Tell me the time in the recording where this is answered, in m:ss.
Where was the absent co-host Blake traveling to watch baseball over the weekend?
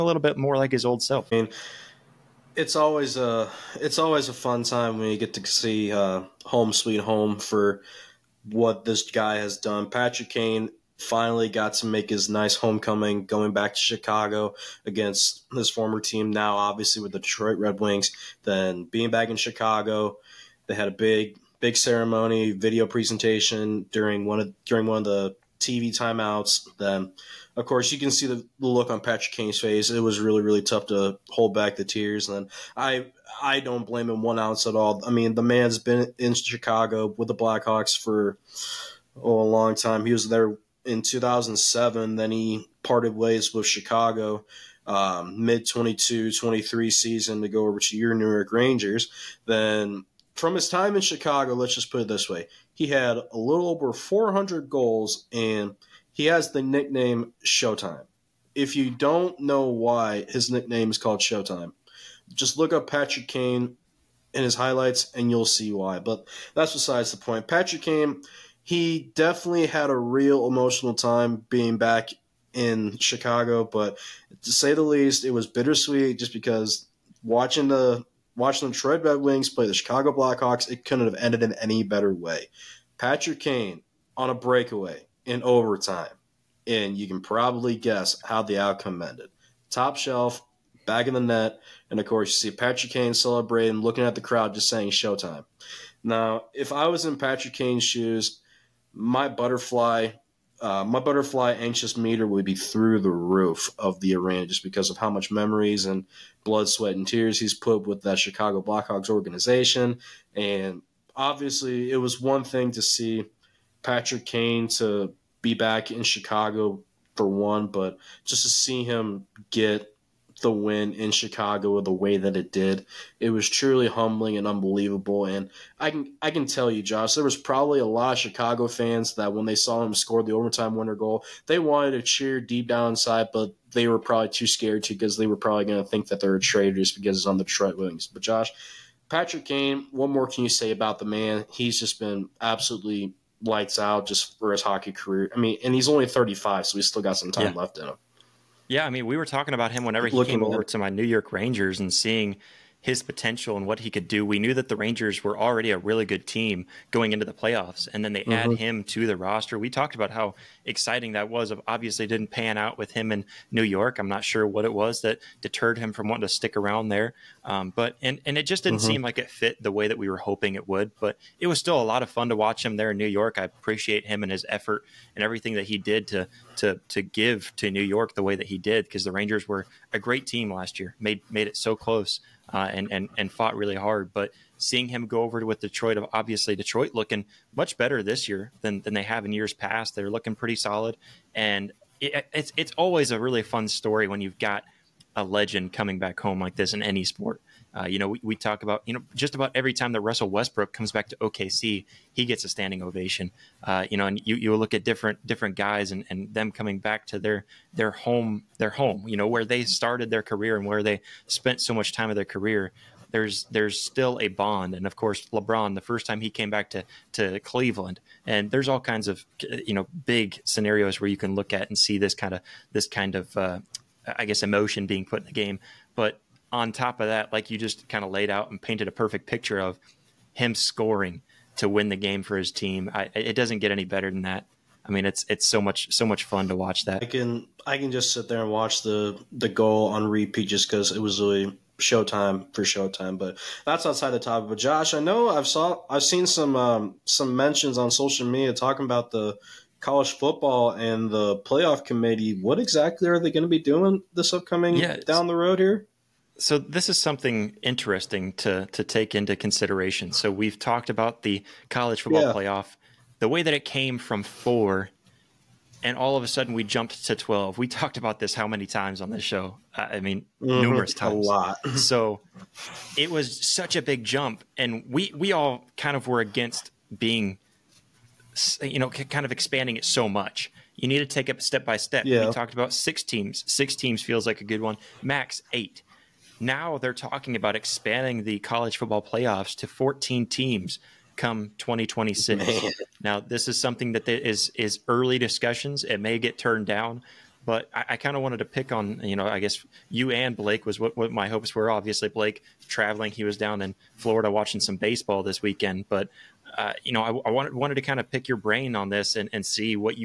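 5:03.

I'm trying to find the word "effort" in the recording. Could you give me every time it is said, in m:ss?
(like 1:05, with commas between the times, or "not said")
2:54.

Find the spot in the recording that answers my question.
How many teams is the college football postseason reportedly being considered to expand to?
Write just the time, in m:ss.
4:49.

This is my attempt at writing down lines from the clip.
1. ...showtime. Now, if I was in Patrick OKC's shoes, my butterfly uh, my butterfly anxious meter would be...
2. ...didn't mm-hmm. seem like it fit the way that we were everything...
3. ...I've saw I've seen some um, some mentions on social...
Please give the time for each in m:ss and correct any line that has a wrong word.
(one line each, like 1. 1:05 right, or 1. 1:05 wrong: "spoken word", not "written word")
1. 1:34 wrong: "Kane", not "OKC"
2. 2:48 wrong: "hoping", not "everything"
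3. 4:05 right.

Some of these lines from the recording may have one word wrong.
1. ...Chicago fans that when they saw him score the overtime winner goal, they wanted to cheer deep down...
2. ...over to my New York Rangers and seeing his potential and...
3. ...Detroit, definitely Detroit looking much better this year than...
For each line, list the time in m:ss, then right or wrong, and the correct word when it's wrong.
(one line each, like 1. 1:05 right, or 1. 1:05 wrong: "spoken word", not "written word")
1. 2:08 right
2. 2:30 right
3. 3:05 wrong: "obviously", not "definitely".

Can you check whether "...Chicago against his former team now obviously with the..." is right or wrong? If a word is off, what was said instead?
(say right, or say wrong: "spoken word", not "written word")
right.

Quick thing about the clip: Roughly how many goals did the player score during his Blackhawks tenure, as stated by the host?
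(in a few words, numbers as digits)
a little over 400.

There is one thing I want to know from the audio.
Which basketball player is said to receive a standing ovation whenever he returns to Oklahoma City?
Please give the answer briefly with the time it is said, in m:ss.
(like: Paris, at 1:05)
Russell Westbrook, at 3:20.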